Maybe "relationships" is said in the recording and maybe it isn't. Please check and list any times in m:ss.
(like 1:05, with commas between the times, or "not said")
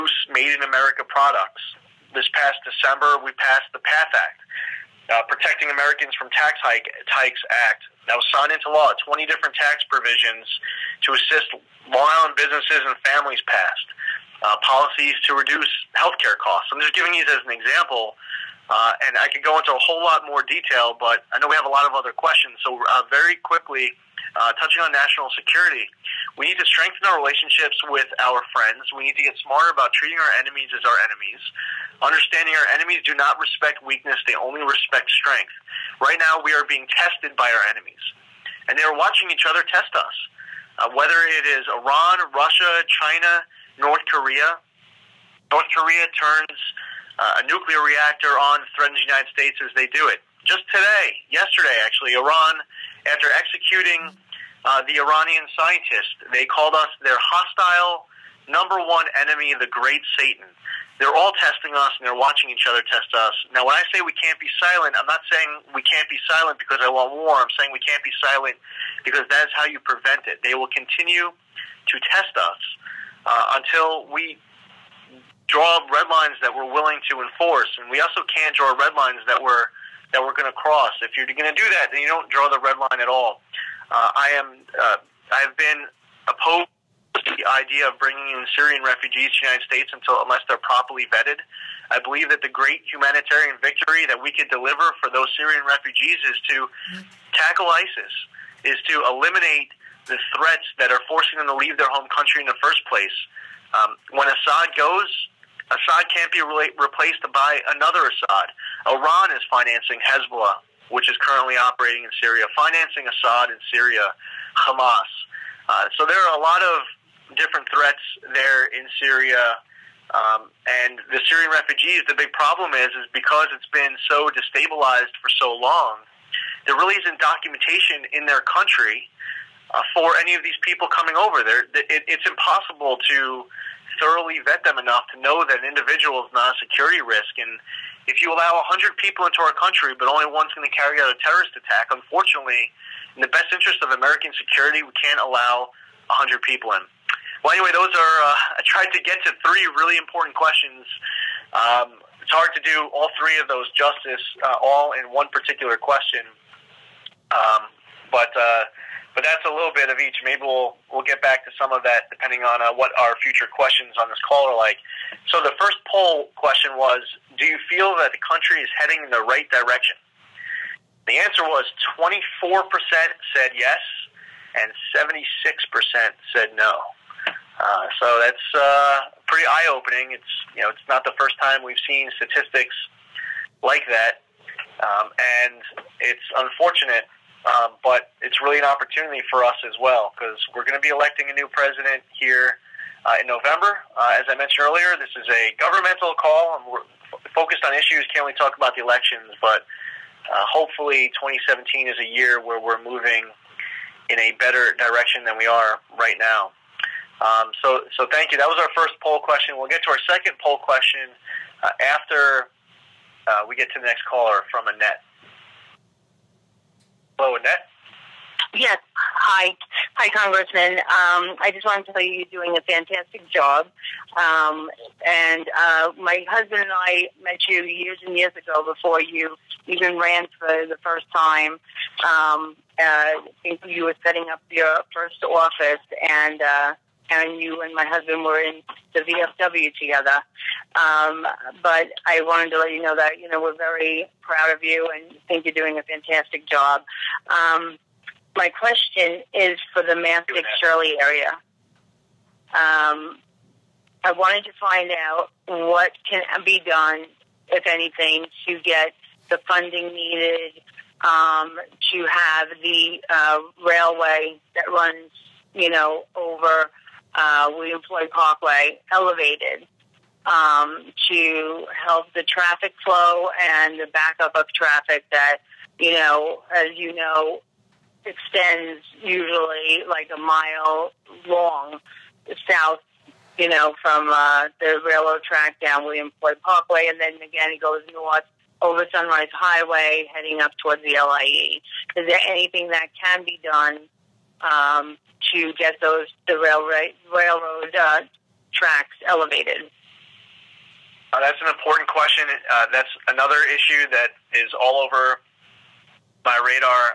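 0:27.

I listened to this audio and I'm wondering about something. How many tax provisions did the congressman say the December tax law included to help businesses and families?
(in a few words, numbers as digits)
20.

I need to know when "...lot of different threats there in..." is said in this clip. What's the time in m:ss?
1:56.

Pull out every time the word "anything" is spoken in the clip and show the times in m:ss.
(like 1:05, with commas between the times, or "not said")
4:17, 4:52.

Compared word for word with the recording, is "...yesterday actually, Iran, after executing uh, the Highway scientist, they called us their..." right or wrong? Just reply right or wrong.
wrong.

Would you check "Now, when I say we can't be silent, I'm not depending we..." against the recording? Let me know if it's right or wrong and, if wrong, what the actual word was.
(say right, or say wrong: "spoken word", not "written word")
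wrong: "saying", not "depending".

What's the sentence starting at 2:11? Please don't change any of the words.
There, it, it's impossible to thoroughly vet them enough to know that an individual is not a security risk.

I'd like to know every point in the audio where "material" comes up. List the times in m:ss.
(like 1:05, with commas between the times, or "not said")
not said.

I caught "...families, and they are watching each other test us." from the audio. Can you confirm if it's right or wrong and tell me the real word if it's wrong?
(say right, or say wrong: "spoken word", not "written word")
wrong: "enemies", not "families".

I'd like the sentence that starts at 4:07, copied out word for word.
Um, my question is for the Mastic Shirley area.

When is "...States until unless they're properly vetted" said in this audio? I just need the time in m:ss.
1:29.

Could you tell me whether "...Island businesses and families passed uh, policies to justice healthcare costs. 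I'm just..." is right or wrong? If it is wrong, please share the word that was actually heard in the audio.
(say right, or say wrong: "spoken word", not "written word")
wrong: "reduce", not "justice".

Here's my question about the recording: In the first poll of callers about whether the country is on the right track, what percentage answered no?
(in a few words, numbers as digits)
76%.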